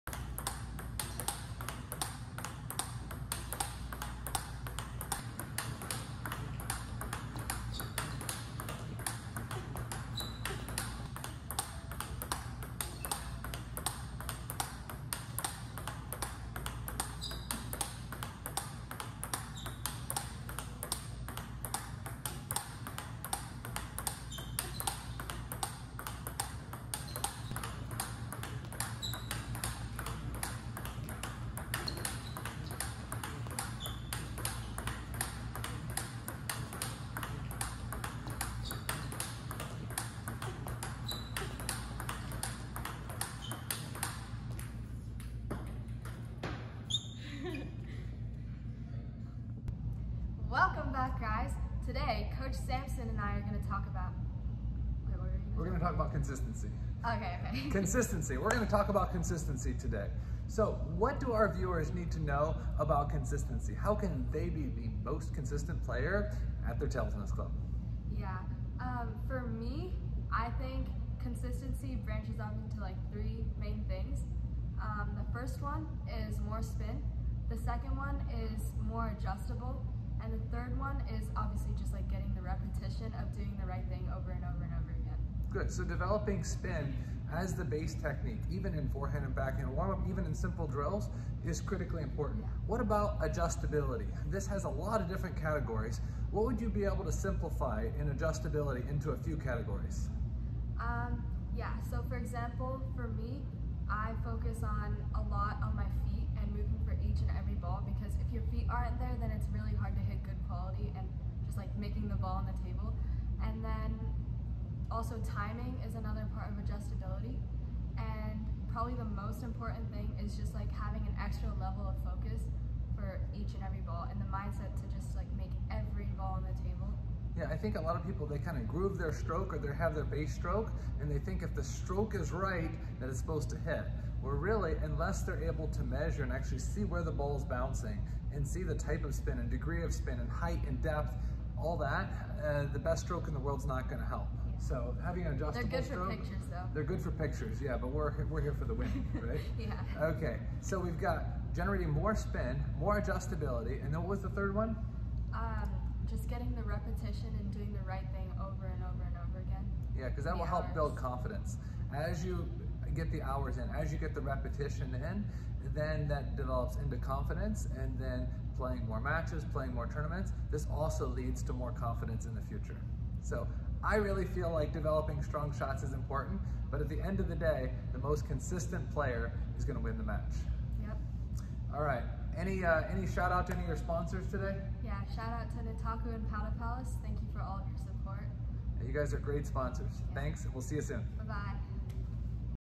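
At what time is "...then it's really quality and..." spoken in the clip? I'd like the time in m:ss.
1:49.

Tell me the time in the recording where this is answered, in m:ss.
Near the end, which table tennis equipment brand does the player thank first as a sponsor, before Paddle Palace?
3:05.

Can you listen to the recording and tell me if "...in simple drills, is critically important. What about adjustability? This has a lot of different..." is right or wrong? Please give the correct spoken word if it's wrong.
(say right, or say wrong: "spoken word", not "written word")
right.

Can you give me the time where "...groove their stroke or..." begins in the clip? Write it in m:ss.
2:08.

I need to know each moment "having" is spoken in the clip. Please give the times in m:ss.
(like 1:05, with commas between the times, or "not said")
2:00, 2:25.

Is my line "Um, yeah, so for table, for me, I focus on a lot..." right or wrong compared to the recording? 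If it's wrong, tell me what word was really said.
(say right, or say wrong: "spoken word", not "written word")
wrong: "example", not "table".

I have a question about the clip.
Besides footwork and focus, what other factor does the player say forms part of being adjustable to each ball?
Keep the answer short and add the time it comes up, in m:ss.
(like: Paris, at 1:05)
Timing, at 1:55.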